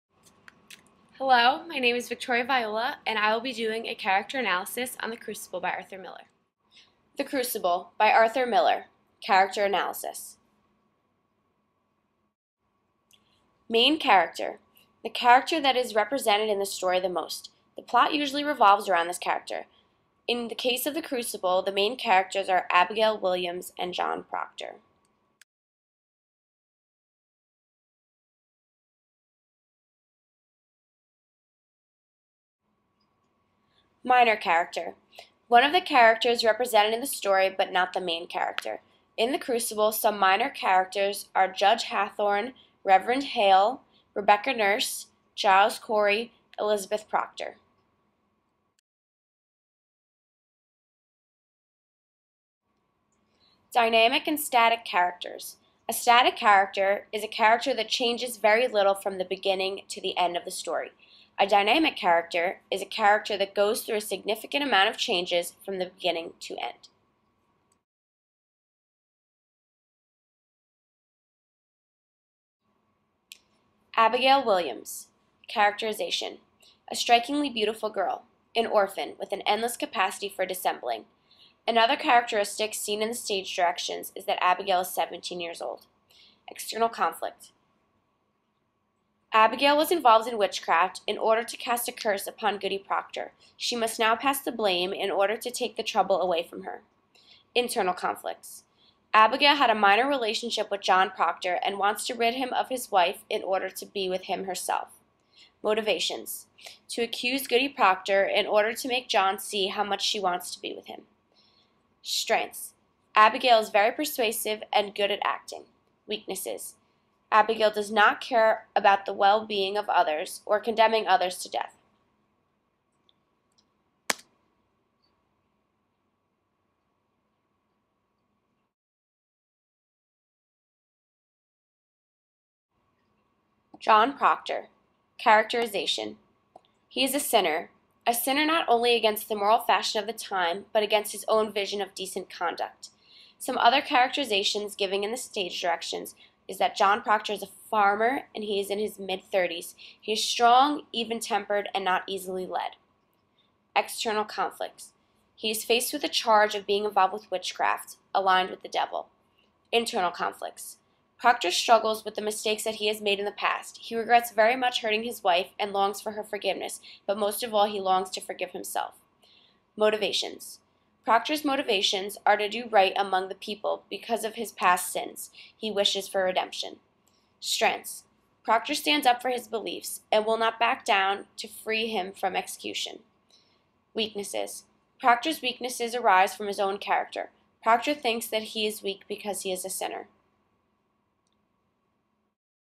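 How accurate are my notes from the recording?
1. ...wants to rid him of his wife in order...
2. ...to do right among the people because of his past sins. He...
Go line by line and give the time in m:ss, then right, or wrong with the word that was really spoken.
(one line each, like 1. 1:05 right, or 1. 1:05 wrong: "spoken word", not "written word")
1. 1:41 right
2. 2:52 right.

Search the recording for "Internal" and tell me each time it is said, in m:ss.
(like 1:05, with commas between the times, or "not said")
1:37, 2:39.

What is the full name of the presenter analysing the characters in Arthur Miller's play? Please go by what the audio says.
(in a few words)
Victoria Viola.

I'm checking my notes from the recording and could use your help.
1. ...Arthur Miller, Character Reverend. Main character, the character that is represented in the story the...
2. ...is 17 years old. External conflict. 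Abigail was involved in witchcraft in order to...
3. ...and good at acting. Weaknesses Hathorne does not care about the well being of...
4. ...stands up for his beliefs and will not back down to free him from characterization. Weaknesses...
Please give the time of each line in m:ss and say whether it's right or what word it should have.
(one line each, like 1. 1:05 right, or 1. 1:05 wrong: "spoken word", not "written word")
1. 0:08 wrong: "Analysis", not "Reverend"
2. 1:24 right
3. 1:54 wrong: "Abigail", not "Hathorne"
4. 2:58 wrong: "execution", not "characterization".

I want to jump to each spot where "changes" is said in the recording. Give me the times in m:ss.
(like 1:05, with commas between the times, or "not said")
0:57, 1:04.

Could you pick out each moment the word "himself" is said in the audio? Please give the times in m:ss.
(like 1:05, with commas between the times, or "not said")
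2:48.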